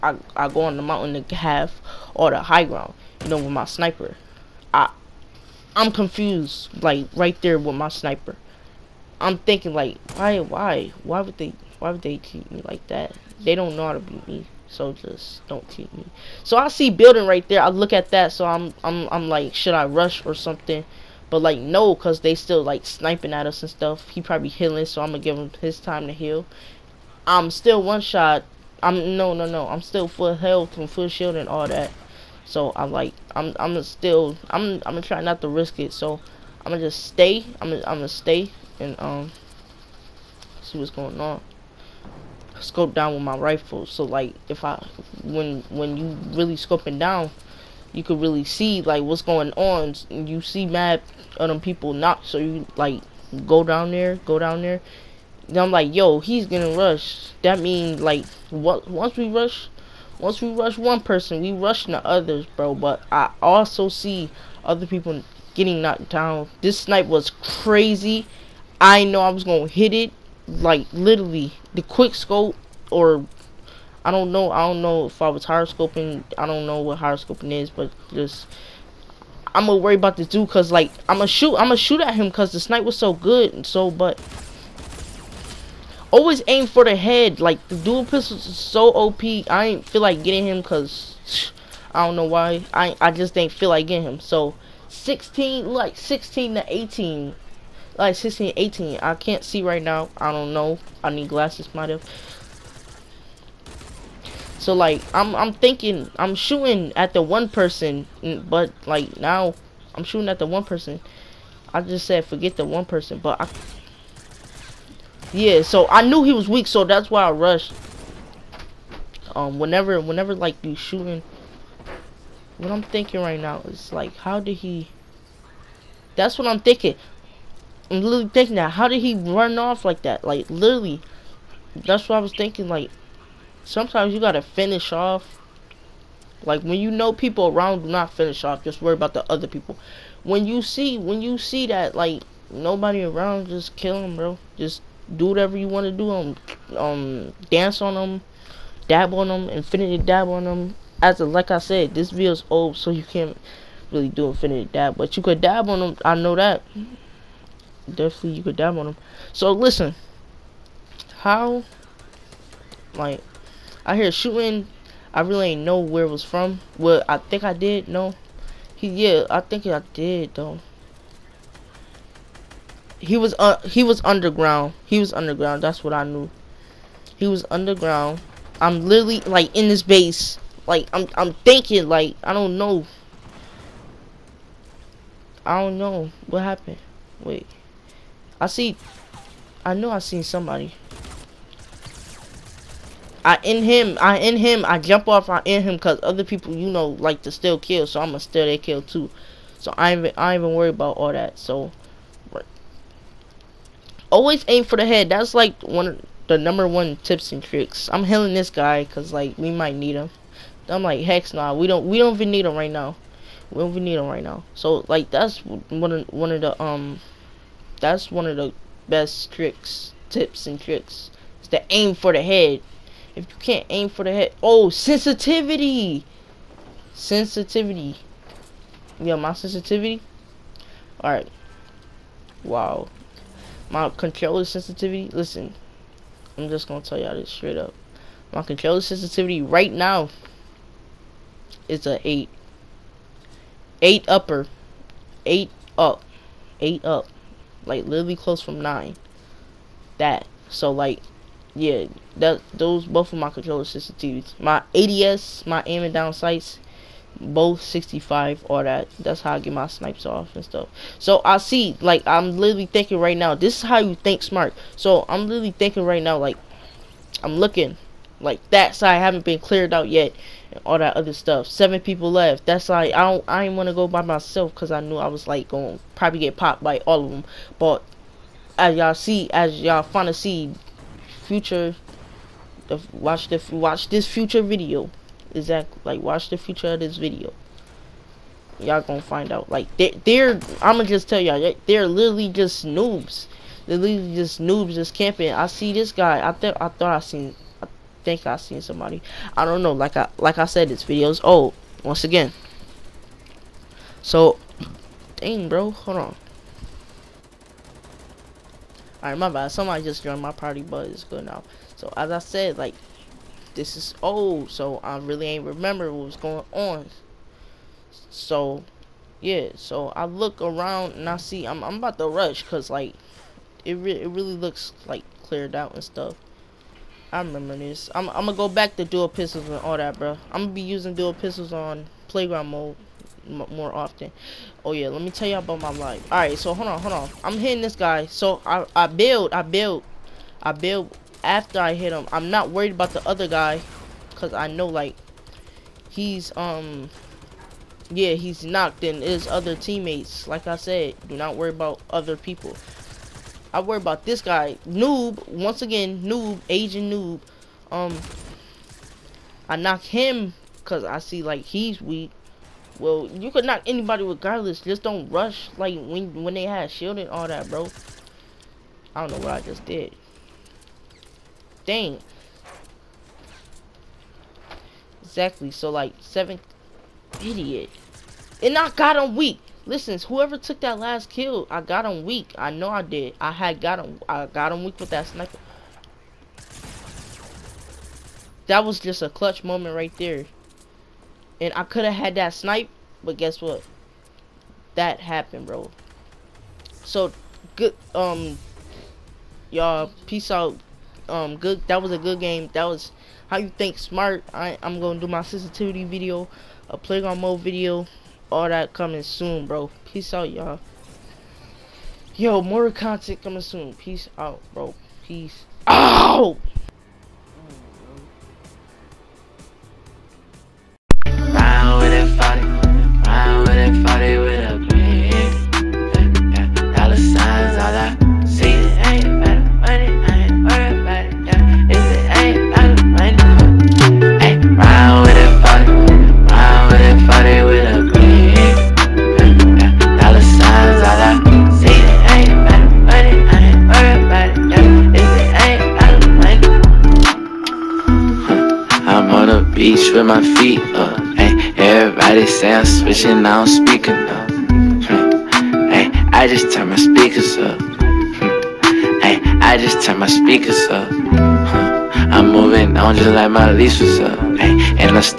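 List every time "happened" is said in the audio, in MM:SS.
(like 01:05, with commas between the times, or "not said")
03:06, 06:35.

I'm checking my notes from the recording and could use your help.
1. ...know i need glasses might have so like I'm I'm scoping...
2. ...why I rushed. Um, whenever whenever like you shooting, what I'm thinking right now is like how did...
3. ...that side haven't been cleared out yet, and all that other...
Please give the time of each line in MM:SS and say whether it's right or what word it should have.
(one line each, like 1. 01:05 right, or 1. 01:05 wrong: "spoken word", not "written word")
1. 01:40 wrong: "thinking", not "scoping"
2. 01:57 right
3. 04:28 right.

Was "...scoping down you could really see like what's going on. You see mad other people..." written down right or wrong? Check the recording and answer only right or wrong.
right.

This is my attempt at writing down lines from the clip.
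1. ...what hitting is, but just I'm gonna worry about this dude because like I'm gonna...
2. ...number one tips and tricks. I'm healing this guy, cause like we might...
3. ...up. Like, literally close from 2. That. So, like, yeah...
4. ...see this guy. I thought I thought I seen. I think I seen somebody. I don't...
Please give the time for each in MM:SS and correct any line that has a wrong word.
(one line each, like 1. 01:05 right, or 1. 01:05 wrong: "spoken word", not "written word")
1. 01:16 wrong: "horoscoping", not "hitting"
2. 03:26 right
3. 04:06 wrong: "9", not "2"
4. 04:55 right.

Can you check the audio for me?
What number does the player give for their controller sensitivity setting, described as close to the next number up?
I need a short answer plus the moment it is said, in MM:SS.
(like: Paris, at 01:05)
8, at 04:01.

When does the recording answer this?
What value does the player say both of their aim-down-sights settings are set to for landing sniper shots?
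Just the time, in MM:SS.
04:17.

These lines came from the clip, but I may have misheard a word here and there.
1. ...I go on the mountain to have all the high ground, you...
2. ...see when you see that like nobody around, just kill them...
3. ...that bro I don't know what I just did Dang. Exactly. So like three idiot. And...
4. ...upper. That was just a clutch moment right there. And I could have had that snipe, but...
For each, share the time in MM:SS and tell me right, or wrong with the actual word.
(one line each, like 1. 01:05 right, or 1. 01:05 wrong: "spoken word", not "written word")
1. 00:00 right
2. 02:20 right
3. 06:07 wrong: "seven", not "three"
4. 06:25 wrong: "sniper", not "upper".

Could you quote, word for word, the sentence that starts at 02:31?
As a, like I said, this video's old, so you can't really do infinity dab, but you could dab on them.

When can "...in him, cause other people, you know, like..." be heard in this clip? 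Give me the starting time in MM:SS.
03:15.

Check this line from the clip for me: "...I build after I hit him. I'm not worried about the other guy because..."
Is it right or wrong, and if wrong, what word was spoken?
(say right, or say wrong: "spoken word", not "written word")
right.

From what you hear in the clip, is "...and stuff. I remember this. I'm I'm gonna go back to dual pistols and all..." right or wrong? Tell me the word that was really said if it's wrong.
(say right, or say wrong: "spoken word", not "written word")
right.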